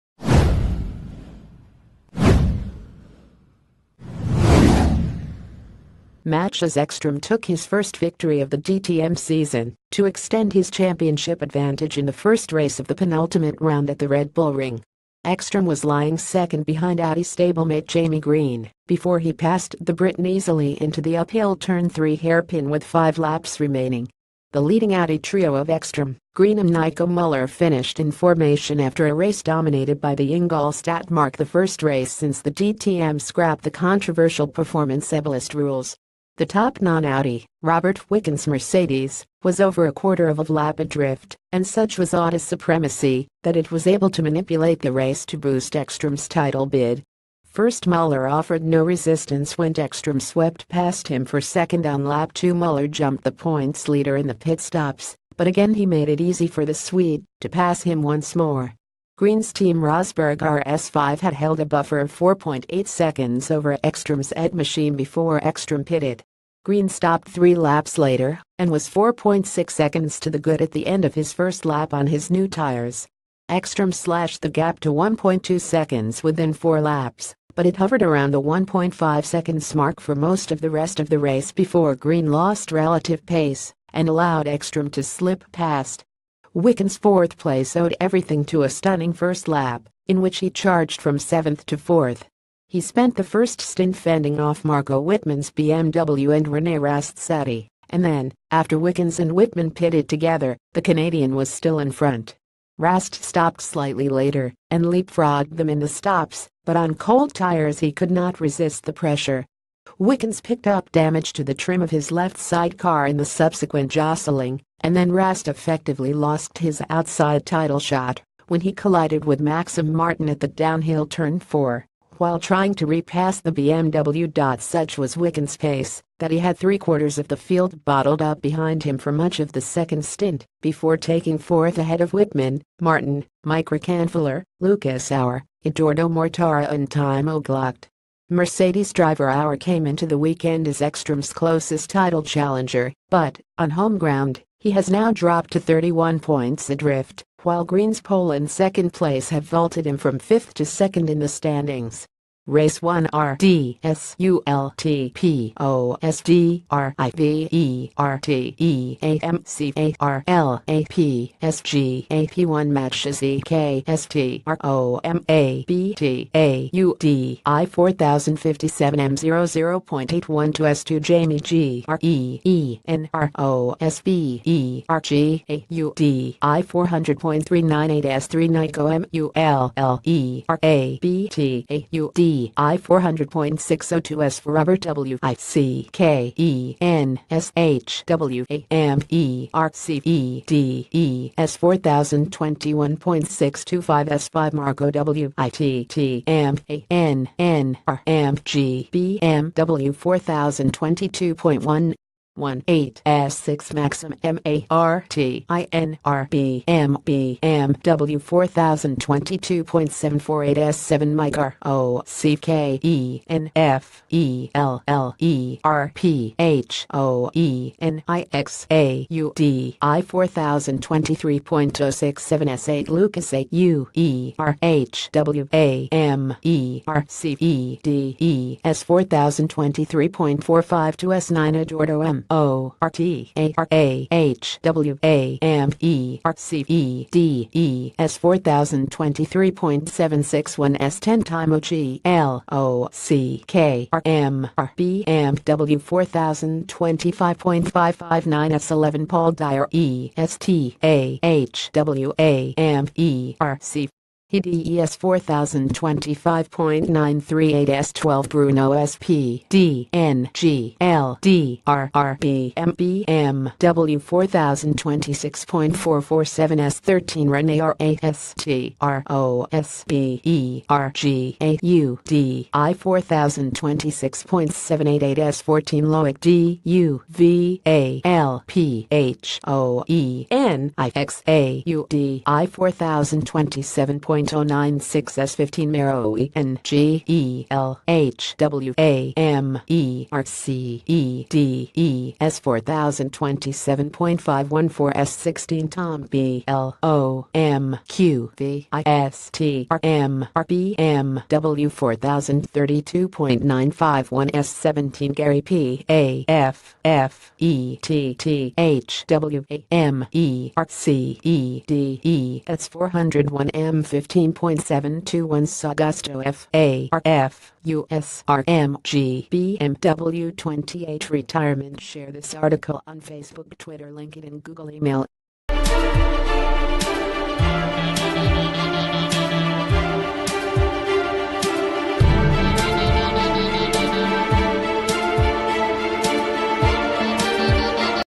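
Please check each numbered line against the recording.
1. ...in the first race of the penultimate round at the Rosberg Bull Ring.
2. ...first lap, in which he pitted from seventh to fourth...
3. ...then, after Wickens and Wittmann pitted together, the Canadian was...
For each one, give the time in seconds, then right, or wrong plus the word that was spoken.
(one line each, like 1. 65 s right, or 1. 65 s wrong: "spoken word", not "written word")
1. 11 s wrong: "Red", not "Rosberg"
2. 89 s wrong: "charged", not "pitted"
3. 98 s right.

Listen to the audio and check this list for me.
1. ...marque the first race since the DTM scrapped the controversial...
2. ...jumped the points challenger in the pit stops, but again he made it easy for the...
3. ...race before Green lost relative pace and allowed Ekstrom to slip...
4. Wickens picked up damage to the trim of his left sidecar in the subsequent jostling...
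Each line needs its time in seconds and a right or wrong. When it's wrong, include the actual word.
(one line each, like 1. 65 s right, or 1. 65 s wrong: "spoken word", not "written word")
1. 31 s right
2. 52 s wrong: "leader", not "challenger"
3. 81 s right
4. 109 s right.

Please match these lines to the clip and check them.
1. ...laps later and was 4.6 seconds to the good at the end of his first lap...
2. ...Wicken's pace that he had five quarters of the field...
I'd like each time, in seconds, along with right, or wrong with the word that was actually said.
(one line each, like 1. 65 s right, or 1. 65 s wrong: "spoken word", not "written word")
1. 67 s right
2. 125 s wrong: "three", not "five".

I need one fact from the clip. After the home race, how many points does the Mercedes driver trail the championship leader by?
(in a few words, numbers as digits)
31 points.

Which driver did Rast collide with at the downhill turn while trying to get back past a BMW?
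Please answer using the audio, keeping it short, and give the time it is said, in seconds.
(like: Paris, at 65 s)
Maxime Martin, at 119 s.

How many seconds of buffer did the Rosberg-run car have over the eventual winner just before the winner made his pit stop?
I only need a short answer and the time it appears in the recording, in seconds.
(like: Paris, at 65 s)
4.8 seconds, at 62 s.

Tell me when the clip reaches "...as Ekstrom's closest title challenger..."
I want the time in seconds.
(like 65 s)
140 s.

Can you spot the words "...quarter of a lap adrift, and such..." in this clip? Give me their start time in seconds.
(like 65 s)
39 s.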